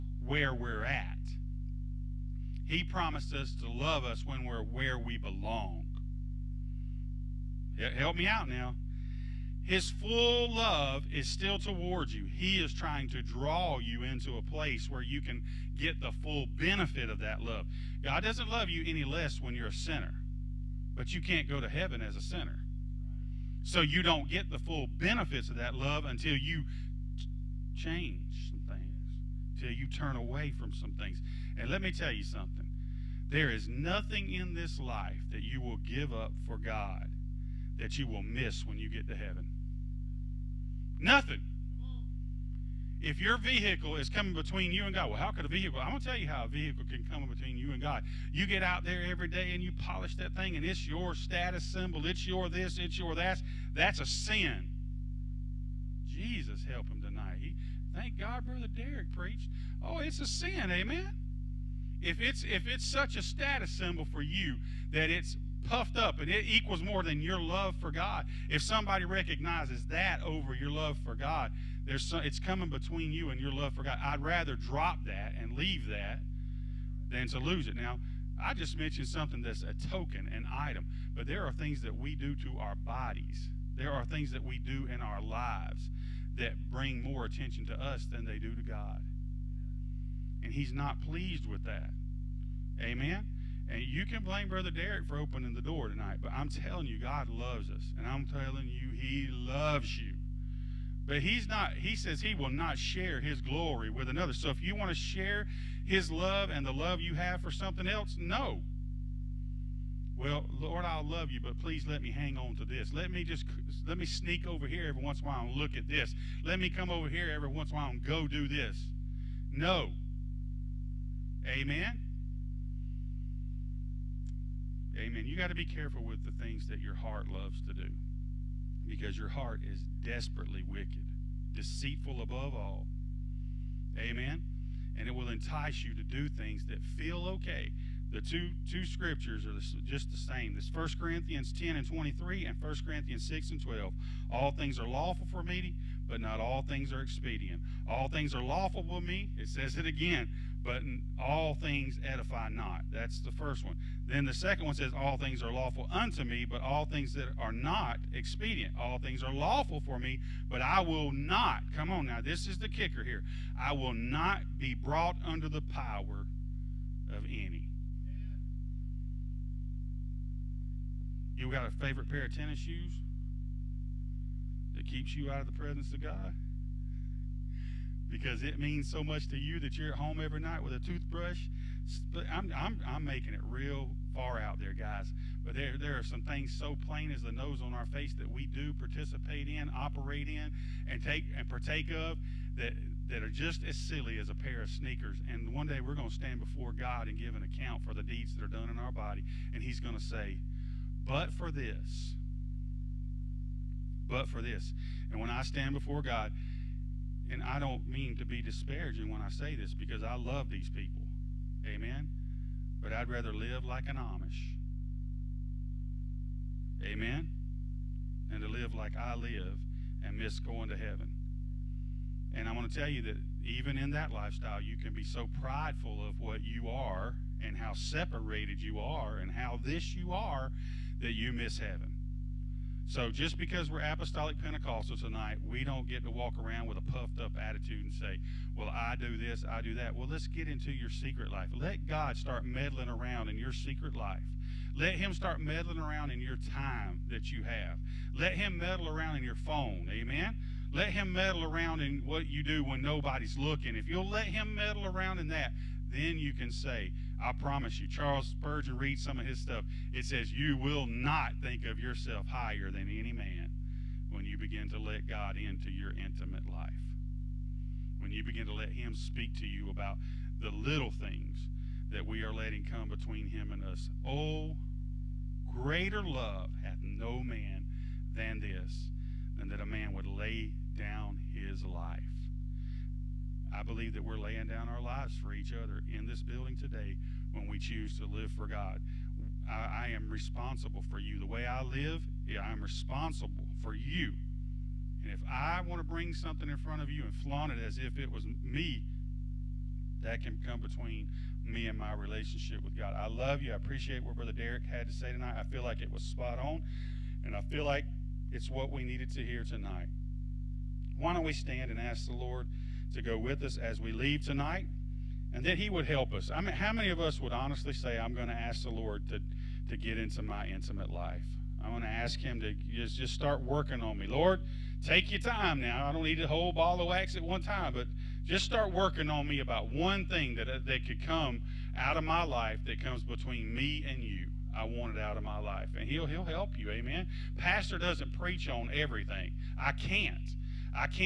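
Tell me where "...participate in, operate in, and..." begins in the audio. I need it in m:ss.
3:08.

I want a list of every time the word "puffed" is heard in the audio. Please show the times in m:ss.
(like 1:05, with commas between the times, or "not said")
1:05, 3:56.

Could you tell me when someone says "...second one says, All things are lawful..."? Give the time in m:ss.
2:34.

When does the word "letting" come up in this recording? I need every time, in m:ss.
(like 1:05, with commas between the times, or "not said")
4:32.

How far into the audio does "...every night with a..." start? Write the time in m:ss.
3:00.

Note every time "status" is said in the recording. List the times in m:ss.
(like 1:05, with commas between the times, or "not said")
0:51, 1:03.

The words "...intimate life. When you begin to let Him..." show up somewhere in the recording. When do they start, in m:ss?
4:25.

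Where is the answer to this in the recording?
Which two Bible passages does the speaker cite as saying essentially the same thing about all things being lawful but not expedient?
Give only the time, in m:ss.
2:20.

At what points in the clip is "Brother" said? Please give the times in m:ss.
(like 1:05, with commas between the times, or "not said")
0:58, 1:34, 5:04.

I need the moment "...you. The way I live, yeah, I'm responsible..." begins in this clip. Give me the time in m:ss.
4:50.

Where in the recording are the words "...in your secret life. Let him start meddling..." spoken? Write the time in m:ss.
4:03.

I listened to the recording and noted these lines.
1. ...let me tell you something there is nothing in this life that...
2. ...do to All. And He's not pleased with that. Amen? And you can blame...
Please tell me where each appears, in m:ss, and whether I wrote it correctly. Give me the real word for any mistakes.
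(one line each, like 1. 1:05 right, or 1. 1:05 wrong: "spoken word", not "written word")
1. 0:31 right
2. 1:28 wrong: "God", not "All".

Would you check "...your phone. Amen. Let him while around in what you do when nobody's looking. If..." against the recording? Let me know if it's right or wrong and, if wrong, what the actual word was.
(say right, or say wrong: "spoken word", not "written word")
wrong: "meddle", not "while".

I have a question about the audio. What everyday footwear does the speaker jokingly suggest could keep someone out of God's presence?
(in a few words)
tennis shoes.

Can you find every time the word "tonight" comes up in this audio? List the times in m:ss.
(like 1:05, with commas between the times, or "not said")
0:57, 1:35, 3:54, 5:05, 5:09, 5:14.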